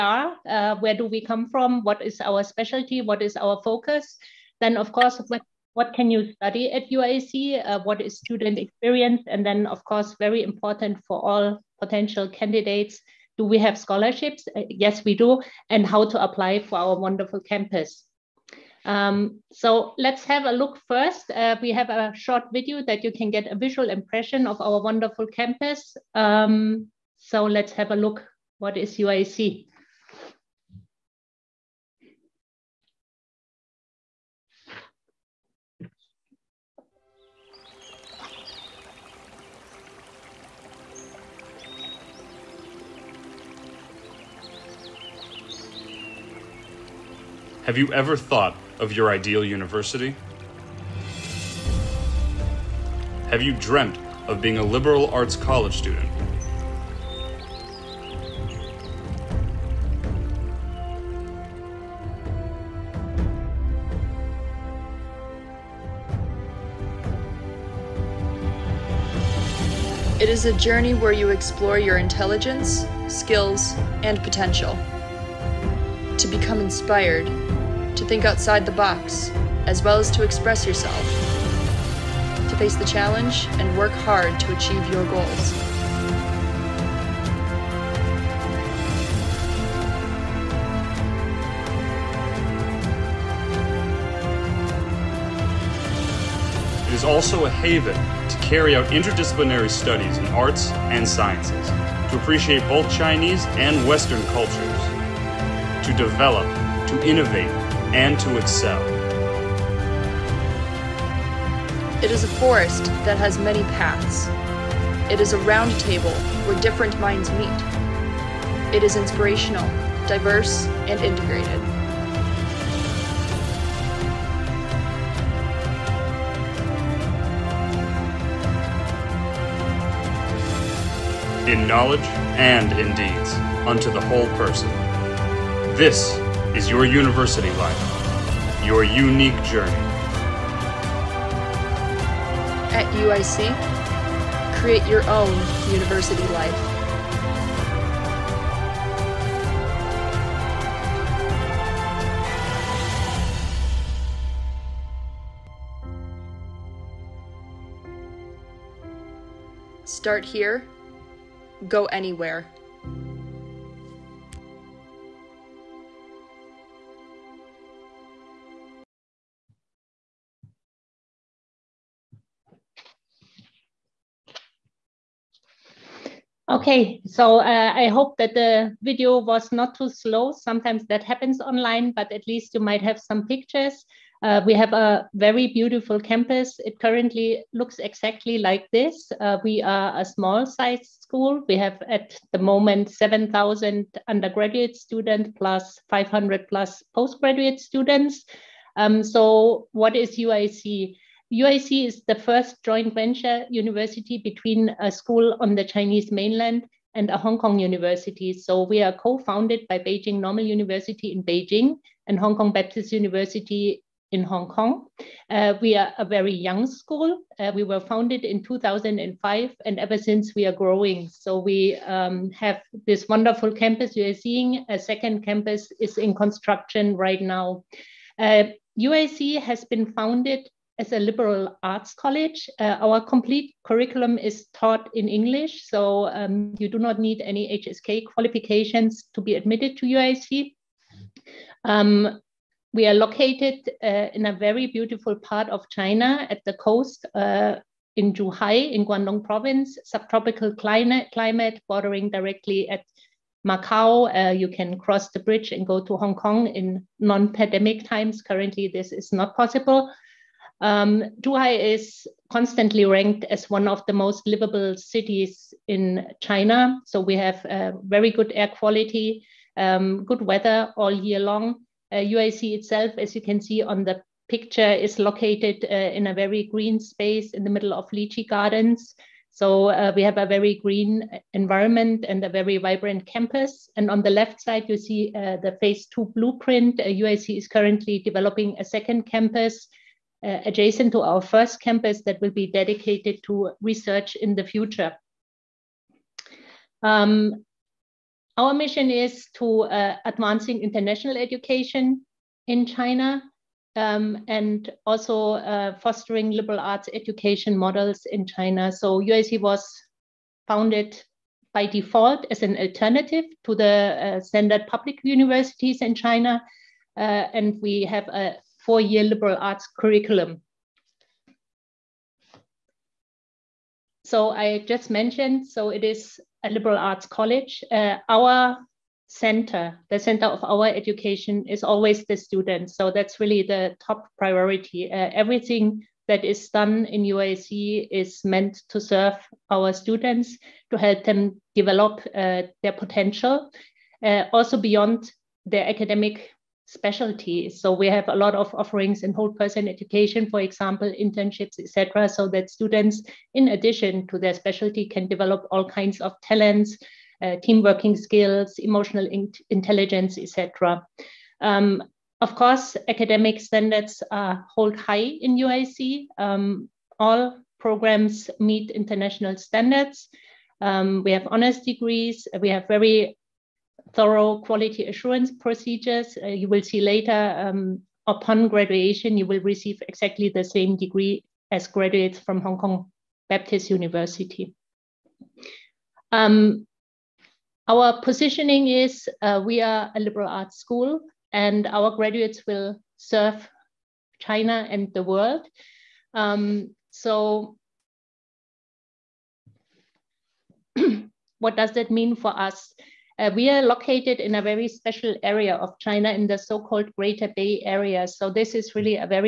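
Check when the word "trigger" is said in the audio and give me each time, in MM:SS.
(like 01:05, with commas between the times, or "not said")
not said.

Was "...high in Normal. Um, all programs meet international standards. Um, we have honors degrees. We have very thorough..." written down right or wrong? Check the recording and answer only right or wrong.
wrong.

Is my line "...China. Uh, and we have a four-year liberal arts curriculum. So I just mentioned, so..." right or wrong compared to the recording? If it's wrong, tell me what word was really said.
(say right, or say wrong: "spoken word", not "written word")
right.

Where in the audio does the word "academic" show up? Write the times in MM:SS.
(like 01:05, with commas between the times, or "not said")
05:45, 06:02.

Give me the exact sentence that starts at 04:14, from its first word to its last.
Uh, you can cross the bridge and go to Hong Kong in non-pandemic times.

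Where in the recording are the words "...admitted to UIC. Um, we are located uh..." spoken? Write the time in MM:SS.
03:59.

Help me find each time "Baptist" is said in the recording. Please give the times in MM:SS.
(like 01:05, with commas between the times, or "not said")
03:32, 06:23.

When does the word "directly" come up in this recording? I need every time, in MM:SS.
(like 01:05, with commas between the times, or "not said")
04:12.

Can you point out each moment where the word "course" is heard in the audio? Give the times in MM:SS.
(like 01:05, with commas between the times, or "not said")
00:04, 00:09, 06:02.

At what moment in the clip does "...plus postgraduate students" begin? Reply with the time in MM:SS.
03:16.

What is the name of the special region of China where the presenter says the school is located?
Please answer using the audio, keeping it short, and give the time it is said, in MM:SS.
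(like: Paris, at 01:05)
Greater Bay Area, at 06:46.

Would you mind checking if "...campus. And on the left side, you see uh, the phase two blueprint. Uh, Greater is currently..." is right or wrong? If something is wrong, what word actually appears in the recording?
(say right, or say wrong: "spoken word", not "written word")
wrong: "UIC", not "Greater".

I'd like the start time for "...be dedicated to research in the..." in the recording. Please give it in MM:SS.
04:52.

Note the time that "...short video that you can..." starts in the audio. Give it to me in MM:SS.
00:22.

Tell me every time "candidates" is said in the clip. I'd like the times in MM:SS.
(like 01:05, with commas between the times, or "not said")
00:12.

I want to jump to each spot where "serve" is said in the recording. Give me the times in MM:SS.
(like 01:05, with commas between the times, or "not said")
05:38, 06:32.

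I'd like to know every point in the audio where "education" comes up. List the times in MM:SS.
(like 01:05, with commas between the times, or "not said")
05:01, 05:06, 05:30, 05:49.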